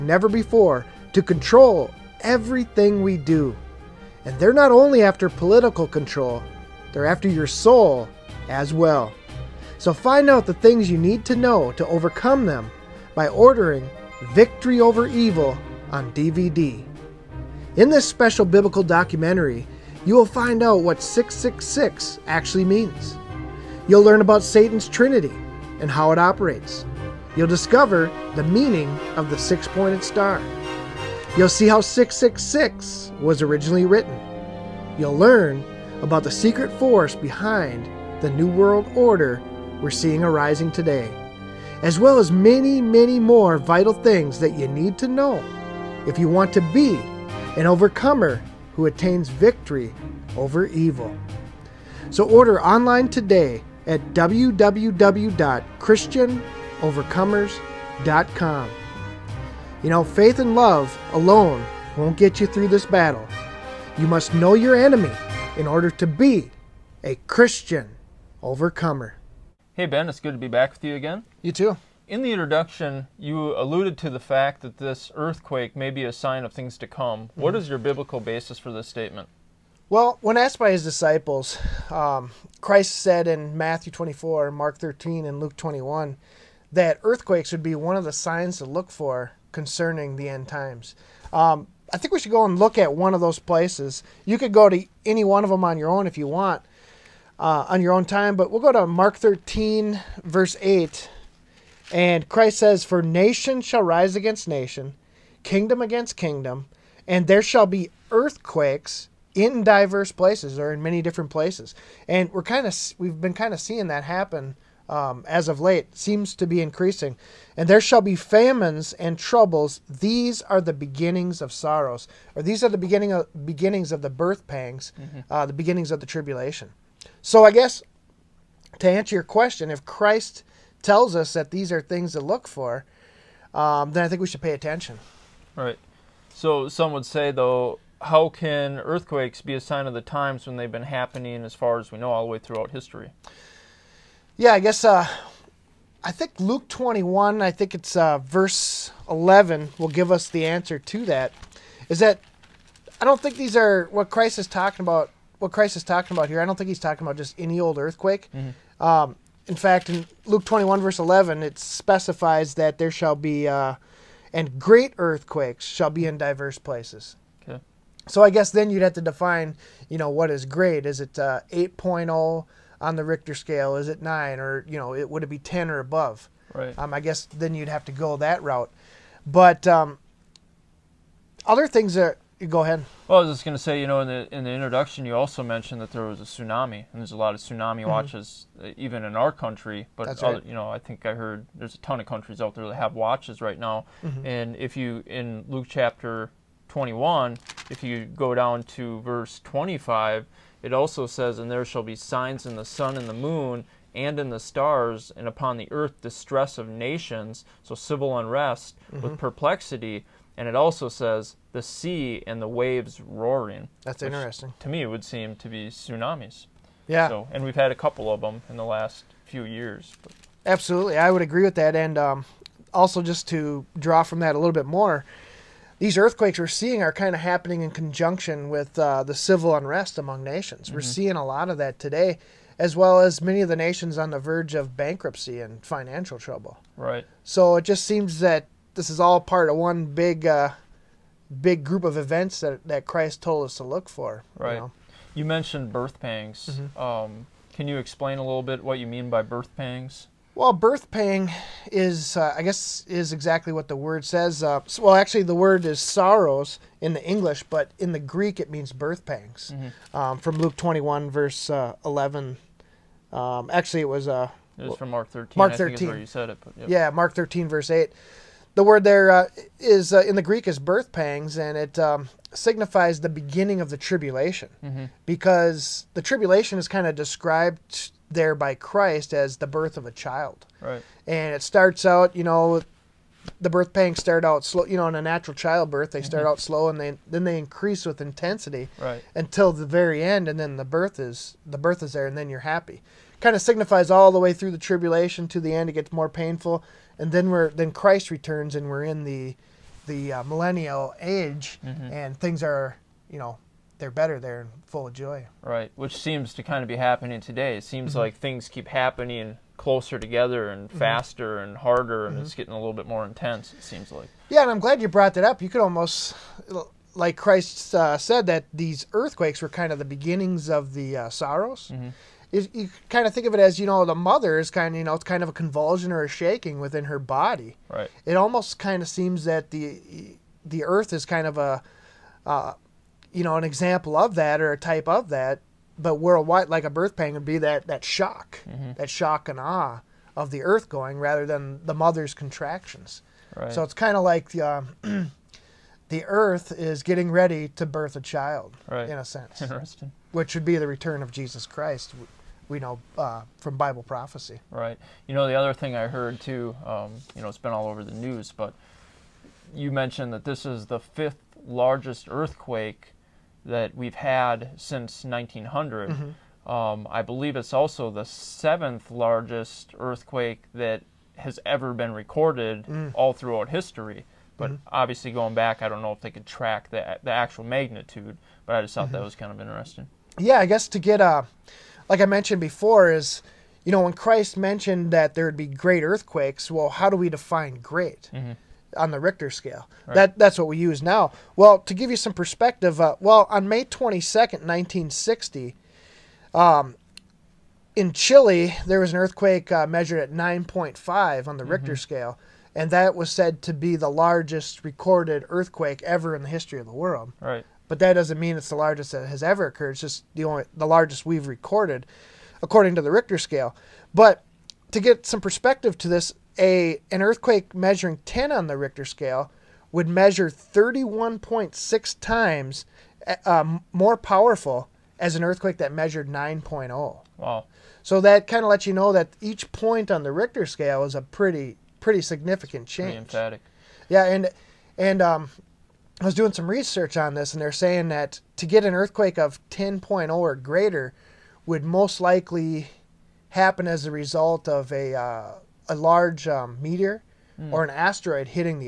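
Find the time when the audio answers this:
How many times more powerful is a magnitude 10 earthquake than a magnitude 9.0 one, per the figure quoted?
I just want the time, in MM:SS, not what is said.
07:00.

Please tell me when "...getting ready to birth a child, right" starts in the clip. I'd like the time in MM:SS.
05:46.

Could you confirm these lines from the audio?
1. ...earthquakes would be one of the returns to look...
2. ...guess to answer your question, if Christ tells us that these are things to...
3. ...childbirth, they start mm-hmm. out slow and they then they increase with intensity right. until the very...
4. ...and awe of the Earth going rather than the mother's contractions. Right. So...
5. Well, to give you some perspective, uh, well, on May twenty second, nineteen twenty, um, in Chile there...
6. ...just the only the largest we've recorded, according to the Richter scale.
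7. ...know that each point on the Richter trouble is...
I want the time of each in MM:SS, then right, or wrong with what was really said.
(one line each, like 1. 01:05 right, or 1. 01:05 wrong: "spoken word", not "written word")
1. 01:27 wrong: "signs", not "returns"
2. 02:07 right
3. 04:45 right
4. 05:39 right
5. 06:31 wrong: "sixty", not "twenty"
6. 06:49 right
7. 07:08 wrong: "scale", not "trouble".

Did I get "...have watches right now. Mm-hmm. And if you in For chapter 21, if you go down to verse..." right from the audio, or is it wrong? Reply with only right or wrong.
wrong.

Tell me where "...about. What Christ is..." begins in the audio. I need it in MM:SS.
02:34.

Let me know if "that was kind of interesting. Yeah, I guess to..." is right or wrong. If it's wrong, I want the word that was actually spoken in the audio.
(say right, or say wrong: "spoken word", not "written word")
right.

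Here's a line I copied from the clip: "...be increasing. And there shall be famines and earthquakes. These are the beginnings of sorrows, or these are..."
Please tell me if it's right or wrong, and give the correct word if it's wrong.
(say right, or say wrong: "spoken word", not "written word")
wrong: "troubles", not "earthquakes".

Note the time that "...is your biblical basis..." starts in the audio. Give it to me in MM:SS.
01:17.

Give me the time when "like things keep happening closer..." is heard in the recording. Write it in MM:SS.
05:08.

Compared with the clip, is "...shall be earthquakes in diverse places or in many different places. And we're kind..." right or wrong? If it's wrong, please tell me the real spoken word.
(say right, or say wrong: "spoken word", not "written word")
right.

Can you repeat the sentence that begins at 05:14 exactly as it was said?
Yeah, and I'm glad you brought that up.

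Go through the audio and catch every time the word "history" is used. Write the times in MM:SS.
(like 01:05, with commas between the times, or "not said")
02:22, 06:13, 06:46.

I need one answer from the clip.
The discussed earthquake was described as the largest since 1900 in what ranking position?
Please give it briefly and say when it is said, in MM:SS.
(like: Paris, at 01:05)
fifth, at 06:00.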